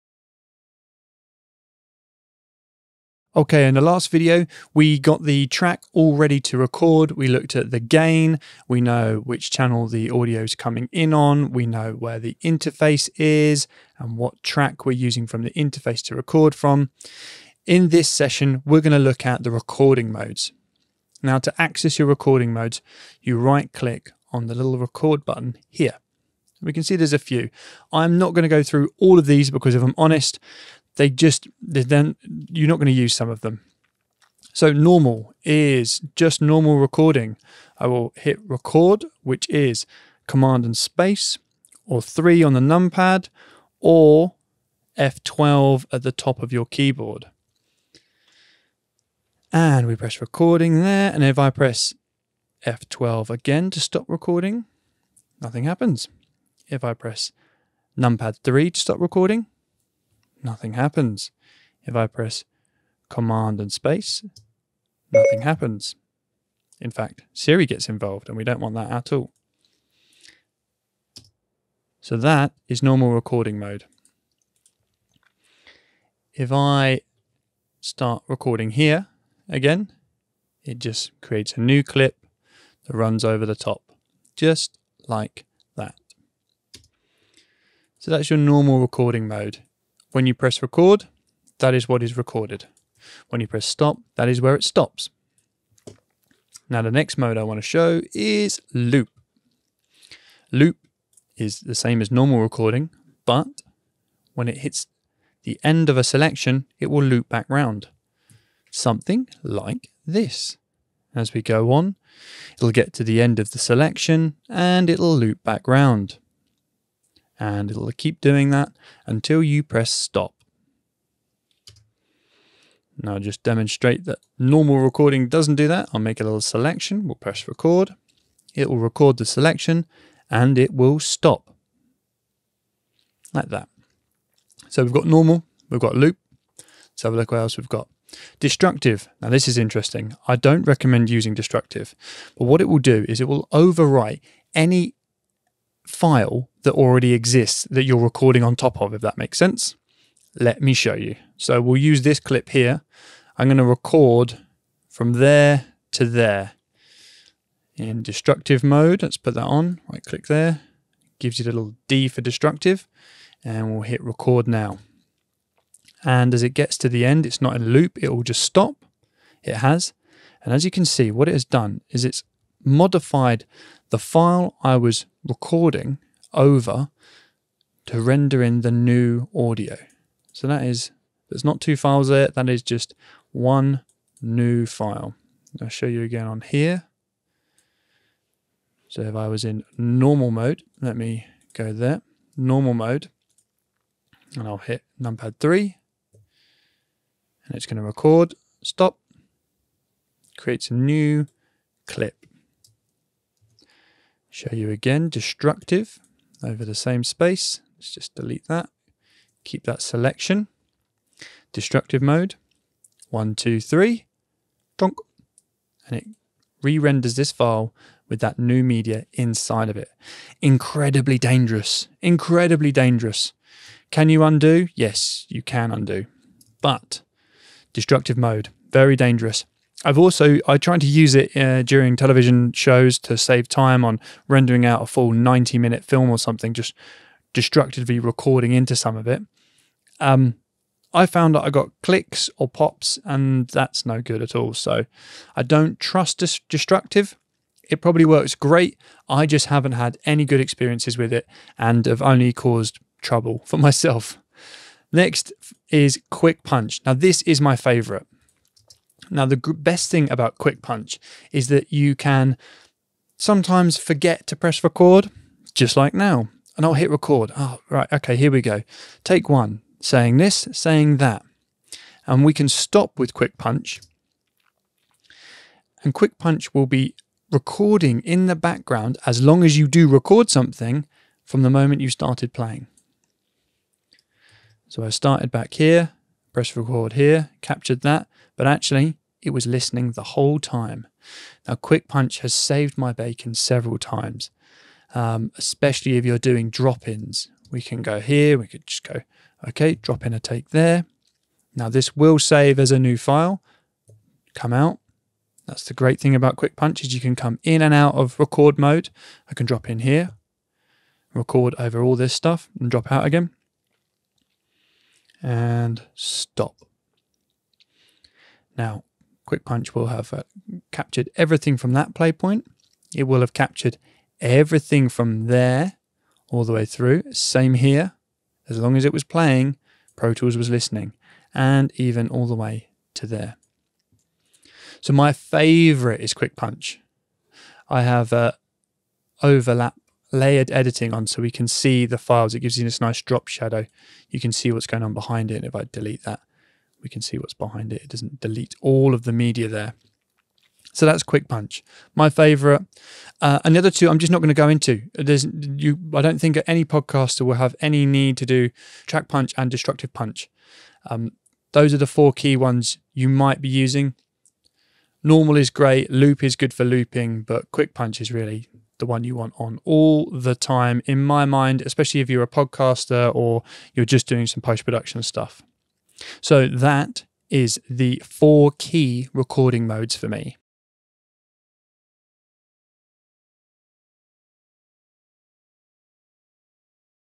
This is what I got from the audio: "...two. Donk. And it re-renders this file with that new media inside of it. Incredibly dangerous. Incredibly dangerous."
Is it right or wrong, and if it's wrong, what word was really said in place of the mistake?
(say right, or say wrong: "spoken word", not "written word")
wrong: "three", not "two".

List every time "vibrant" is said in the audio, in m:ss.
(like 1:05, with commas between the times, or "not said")
not said.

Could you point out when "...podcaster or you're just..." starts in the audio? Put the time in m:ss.
6:12.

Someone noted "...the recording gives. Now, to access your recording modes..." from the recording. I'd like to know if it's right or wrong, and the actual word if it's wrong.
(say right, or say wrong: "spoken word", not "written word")
wrong: "modes", not "gives".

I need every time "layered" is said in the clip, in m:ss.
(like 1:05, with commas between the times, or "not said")
5:40.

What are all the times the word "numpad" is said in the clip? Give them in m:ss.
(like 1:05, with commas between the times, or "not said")
0:42, 0:57, 3:15.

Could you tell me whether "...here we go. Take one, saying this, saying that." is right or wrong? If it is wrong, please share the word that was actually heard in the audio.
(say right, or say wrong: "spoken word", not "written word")
right.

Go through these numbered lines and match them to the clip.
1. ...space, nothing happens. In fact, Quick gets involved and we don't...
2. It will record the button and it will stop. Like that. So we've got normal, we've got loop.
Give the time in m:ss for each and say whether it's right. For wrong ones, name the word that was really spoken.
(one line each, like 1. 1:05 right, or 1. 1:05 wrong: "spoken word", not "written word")
1. 1:03 wrong: "Siri", not "Quick"
2. 2:08 wrong: "selection", not "button".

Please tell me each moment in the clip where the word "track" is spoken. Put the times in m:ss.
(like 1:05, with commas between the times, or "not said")
0:05, 0:14, 5:58.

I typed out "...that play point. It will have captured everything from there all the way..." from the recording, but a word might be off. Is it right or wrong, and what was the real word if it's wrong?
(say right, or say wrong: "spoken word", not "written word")
right.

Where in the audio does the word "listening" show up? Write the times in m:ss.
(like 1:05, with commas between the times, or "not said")
4:49, 5:30.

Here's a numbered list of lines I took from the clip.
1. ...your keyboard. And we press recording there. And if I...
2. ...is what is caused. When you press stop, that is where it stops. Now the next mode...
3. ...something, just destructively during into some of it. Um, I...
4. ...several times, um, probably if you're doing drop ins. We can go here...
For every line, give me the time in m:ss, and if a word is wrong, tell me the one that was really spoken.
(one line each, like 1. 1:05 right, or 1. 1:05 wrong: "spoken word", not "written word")
1. 0:46 right
2. 1:31 wrong: "recorded", not "caused"
3. 3:56 wrong: "recording", not "during"
4. 4:53 wrong: "especially", not "probably".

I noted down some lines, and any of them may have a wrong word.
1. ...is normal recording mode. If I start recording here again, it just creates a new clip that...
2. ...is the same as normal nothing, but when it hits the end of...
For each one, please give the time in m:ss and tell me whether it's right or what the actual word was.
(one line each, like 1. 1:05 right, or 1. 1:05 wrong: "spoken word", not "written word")
1. 1:12 right
2. 1:41 wrong: "recording", not "nothing".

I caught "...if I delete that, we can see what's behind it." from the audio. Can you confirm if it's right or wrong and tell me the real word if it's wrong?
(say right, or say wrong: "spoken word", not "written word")
right.